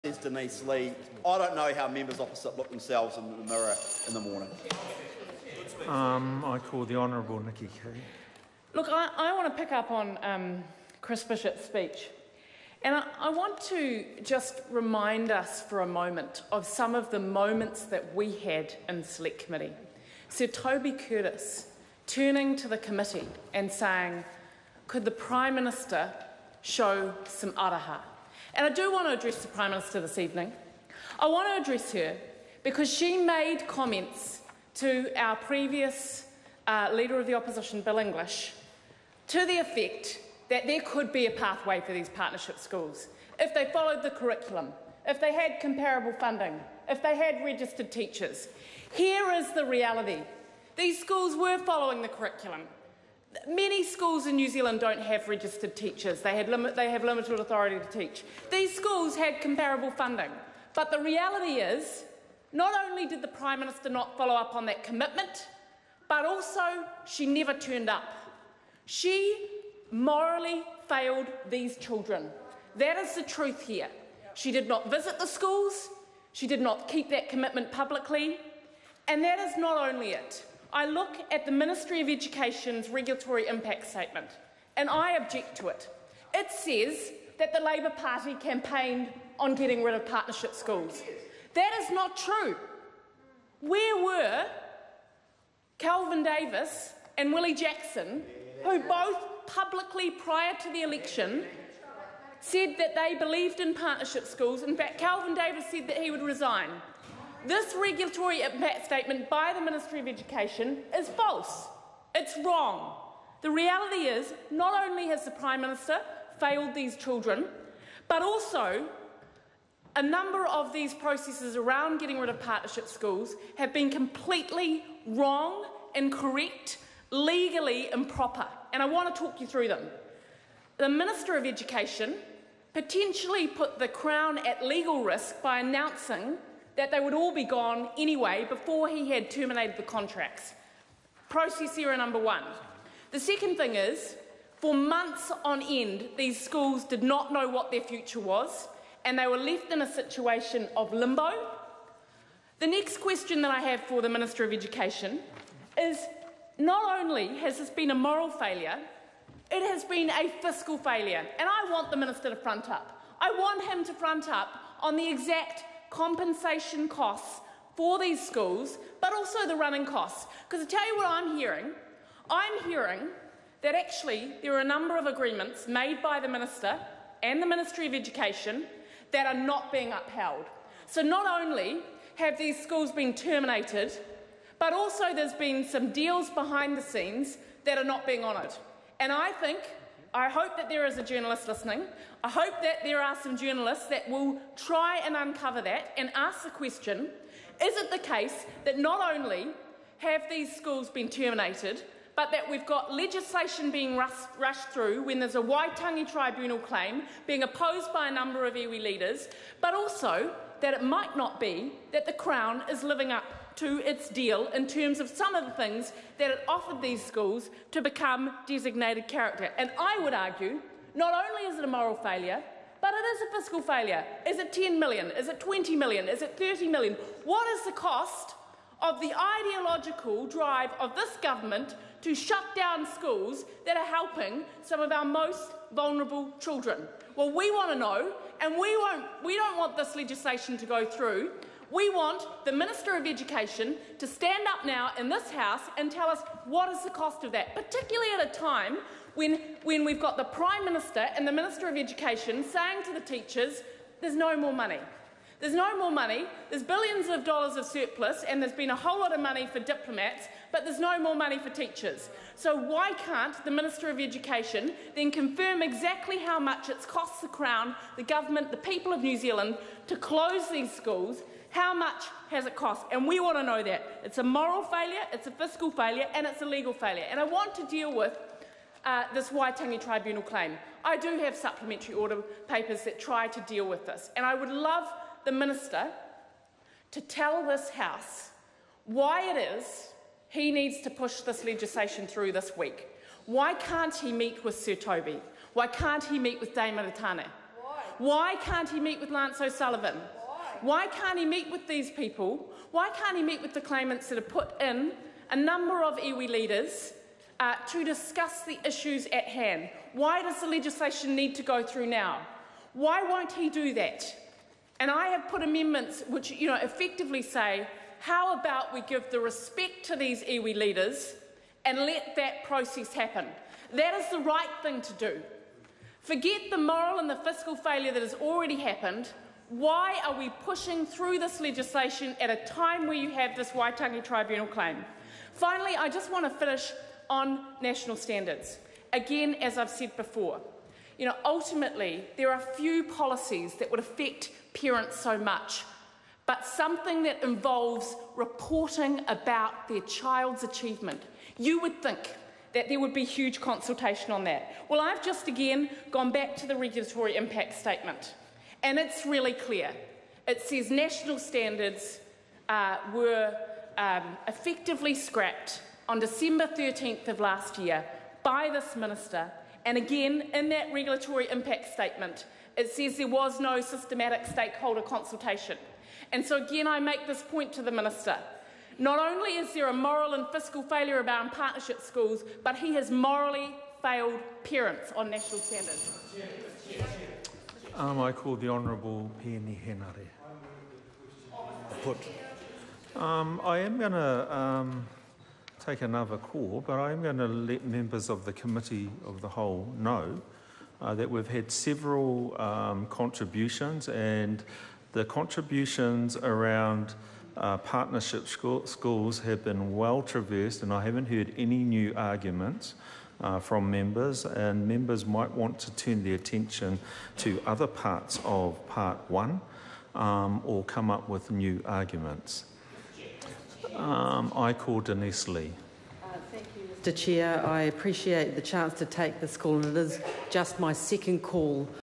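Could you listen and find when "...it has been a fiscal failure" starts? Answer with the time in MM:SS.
02:39.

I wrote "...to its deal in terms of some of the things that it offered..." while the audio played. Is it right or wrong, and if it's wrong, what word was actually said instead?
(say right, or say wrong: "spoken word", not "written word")
right.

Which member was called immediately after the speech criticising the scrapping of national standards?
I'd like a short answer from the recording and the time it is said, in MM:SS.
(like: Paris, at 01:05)
Peeni Henare, at 06:29.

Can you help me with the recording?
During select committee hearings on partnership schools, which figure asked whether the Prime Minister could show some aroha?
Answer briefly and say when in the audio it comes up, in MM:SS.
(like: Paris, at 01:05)
Sir Toby Curtis, at 00:20.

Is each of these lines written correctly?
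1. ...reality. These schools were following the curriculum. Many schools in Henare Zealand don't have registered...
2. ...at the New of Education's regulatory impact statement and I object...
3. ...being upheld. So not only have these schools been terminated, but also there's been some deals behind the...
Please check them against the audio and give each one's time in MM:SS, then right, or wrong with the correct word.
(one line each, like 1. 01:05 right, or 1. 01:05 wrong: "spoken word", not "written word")
1. 00:49 wrong: "New", not "Henare"
2. 01:21 wrong: "Ministry", not "New"
3. 02:59 right.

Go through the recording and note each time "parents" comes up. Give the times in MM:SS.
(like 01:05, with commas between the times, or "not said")
05:44, 06:24.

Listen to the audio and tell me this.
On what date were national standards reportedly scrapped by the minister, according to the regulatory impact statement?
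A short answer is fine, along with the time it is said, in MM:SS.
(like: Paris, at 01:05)
December 13, at 06:05.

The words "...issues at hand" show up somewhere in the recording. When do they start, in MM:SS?
05:08.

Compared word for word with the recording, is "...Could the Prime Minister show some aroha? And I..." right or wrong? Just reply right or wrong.
right.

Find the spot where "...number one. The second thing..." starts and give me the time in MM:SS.
02:21.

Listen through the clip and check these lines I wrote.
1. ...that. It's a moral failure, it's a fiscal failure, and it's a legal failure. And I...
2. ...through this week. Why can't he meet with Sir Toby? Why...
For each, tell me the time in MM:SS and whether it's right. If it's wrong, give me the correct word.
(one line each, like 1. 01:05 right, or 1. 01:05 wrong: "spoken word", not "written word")
1. 04:33 right
2. 04:52 right.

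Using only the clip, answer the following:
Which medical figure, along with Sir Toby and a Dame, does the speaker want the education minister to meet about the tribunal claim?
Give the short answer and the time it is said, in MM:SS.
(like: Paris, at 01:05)
Lance O'Sullivan, at 04:59.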